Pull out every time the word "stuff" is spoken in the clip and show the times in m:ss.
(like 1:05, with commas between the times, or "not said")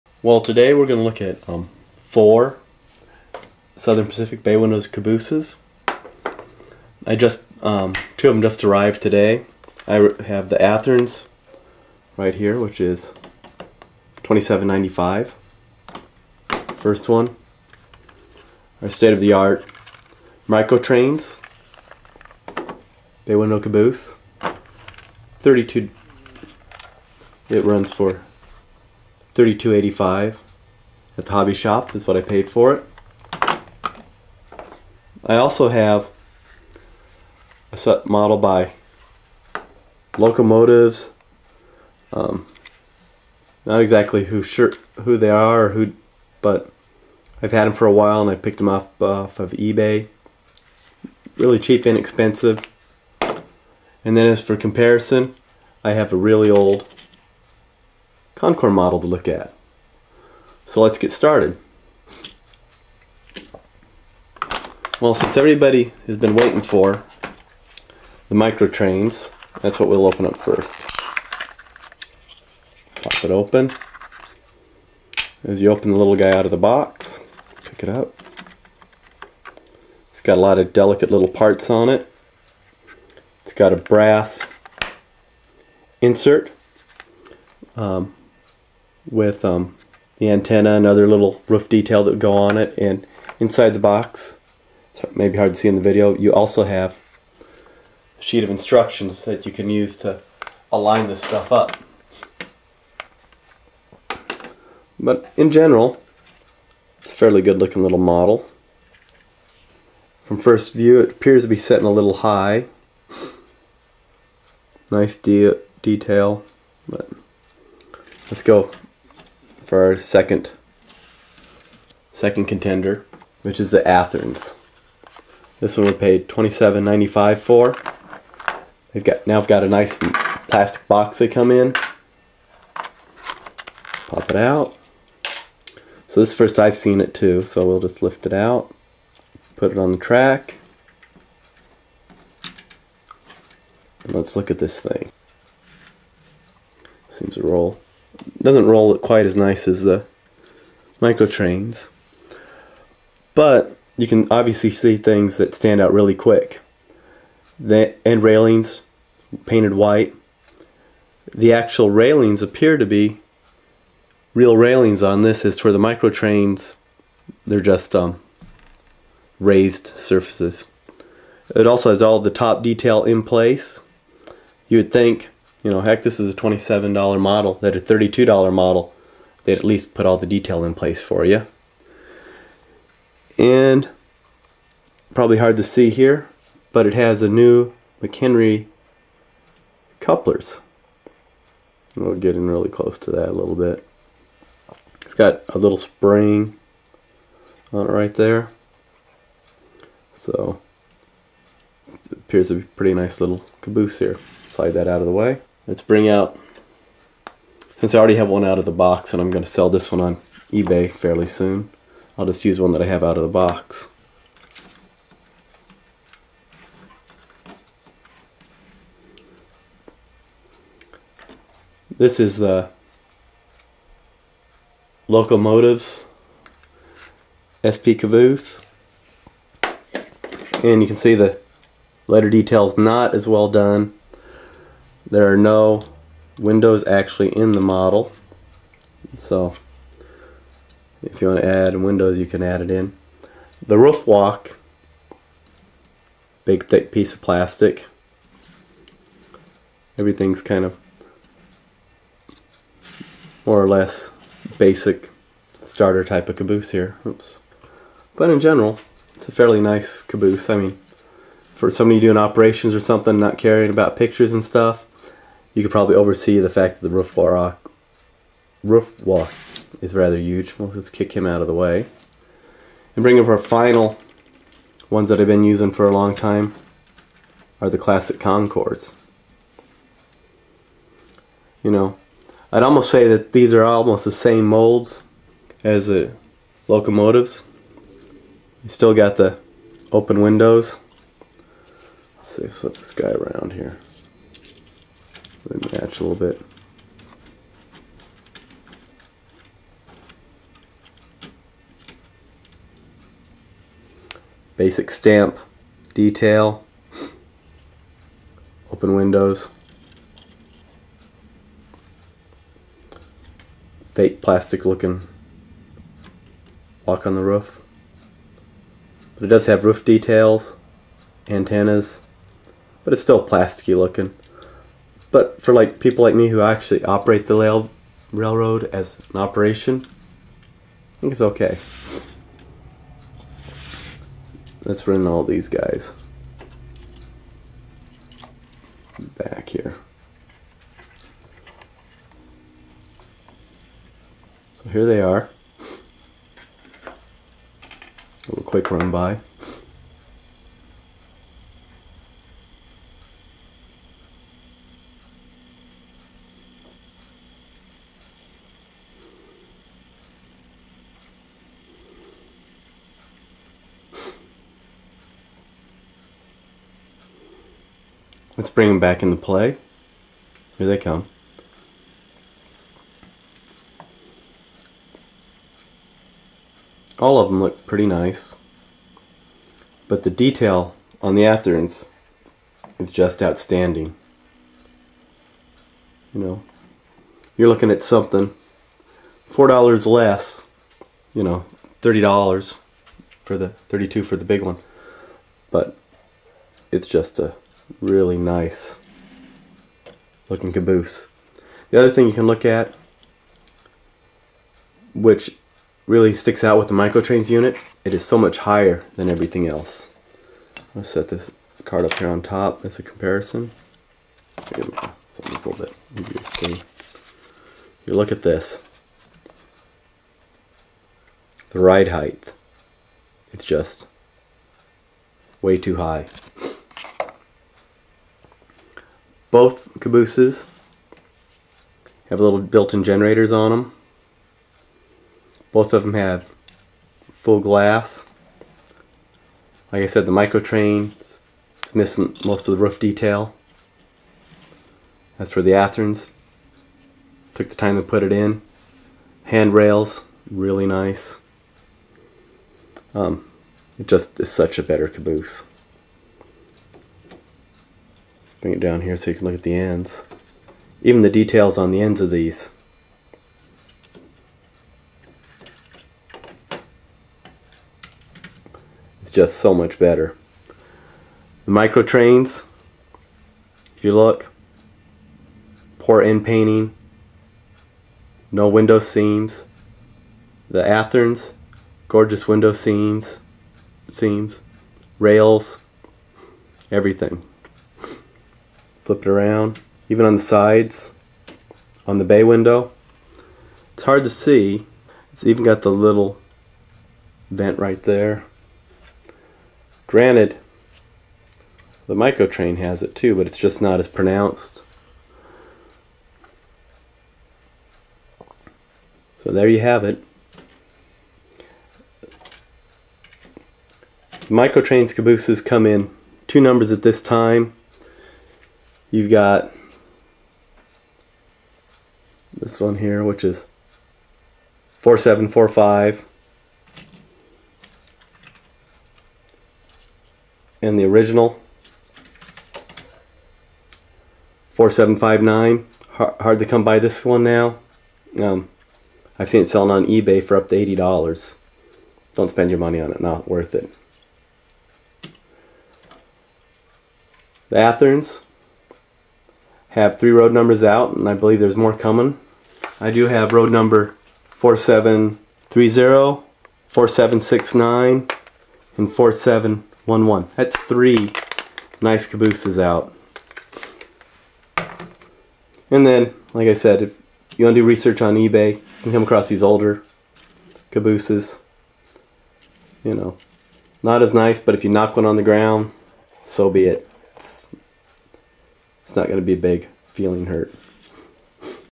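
1:41, 4:24.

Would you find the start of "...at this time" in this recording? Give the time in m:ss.
8:36.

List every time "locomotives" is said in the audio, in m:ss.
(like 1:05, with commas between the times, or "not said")
0:40, 3:45, 4:46.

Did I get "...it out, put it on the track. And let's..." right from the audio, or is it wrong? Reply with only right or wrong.
right.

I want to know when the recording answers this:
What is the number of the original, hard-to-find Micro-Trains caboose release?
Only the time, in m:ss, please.
8:54.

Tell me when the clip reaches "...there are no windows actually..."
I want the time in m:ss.
3:55.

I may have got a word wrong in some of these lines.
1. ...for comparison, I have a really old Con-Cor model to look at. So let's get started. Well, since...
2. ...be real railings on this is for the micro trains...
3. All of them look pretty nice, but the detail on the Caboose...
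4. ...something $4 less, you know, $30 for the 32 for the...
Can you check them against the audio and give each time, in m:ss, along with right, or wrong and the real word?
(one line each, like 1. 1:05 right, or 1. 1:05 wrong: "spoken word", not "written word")
1. 0:54 right
2. 2:42 right
3. 6:16 wrong: "Athearns", not "Caboose"
4. 6:27 right.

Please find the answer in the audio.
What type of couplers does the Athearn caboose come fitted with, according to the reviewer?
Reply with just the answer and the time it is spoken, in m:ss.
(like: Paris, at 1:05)
McHenry couplers, at 3:08.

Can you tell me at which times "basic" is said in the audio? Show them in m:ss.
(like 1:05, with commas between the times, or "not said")
4:14, 5:04.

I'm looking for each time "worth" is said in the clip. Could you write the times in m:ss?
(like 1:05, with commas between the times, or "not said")
9:03.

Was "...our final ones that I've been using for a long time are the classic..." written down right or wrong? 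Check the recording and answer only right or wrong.
right.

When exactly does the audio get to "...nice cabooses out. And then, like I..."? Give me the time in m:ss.
9:21.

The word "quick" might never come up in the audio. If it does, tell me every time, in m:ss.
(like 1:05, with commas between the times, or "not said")
2:36, 5:48.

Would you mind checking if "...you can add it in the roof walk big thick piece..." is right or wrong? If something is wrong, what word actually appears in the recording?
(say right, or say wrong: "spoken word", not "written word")
right.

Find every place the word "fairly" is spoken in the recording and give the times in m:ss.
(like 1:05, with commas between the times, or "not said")
1:47, 3:30, 4:19.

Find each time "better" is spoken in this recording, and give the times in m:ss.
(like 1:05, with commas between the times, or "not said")
7:34, 7:49.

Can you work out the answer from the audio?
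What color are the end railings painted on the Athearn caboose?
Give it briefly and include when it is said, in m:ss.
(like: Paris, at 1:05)
White, at 2:39.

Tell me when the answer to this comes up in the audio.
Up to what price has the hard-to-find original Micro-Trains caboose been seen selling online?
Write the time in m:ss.
9:00.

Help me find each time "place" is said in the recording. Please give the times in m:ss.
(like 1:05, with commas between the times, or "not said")
2:53, 3:00.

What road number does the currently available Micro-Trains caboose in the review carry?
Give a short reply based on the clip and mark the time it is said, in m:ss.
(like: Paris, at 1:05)
4745, at 8:44.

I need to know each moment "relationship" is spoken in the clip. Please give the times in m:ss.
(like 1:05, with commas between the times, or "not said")
not said.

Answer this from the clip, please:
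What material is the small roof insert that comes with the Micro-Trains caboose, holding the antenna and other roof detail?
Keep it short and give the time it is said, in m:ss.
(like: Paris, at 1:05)
Brass, at 1:23.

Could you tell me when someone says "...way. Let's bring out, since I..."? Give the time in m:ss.
3:25.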